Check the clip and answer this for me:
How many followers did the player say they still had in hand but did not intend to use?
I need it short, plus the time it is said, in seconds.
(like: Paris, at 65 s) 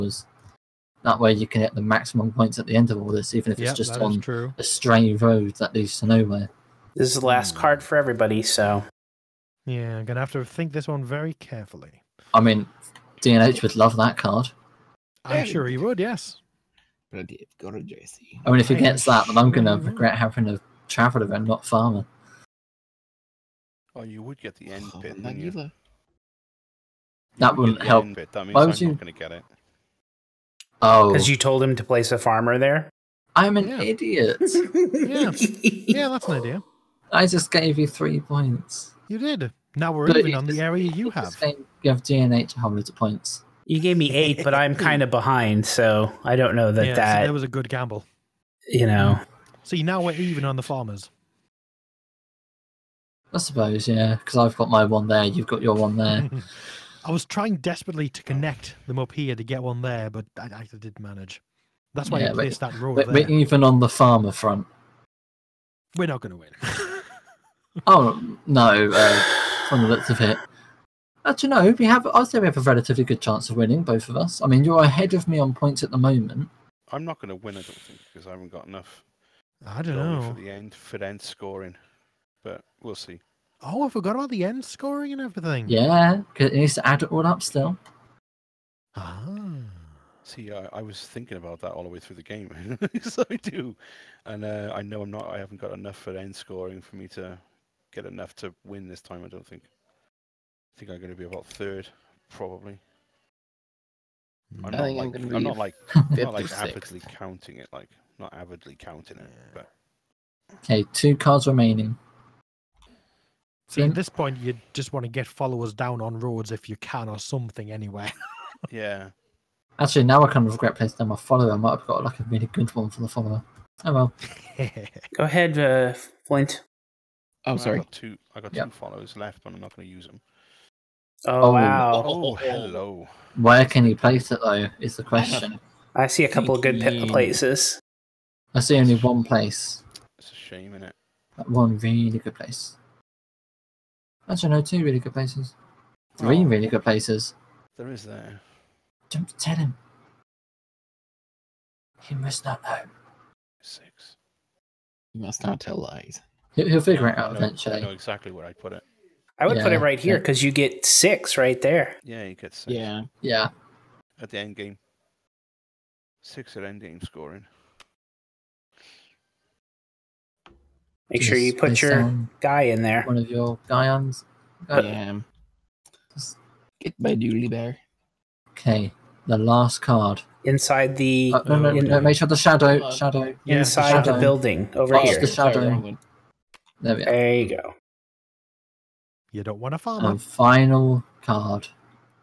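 2, at 128 s.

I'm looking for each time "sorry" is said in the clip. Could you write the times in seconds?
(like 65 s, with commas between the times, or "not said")
127 s.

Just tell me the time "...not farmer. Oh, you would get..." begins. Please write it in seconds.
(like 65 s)
21 s.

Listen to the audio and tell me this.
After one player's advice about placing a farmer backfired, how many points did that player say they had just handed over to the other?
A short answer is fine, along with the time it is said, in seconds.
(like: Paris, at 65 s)
3, at 37 s.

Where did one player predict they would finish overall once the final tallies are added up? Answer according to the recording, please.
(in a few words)
Third.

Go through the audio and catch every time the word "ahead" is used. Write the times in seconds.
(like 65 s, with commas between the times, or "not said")
74 s, 125 s.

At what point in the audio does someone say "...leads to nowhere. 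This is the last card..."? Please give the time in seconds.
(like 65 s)
5 s.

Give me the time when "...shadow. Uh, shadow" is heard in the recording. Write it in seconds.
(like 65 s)
182 s.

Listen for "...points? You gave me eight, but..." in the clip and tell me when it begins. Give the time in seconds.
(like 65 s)
42 s.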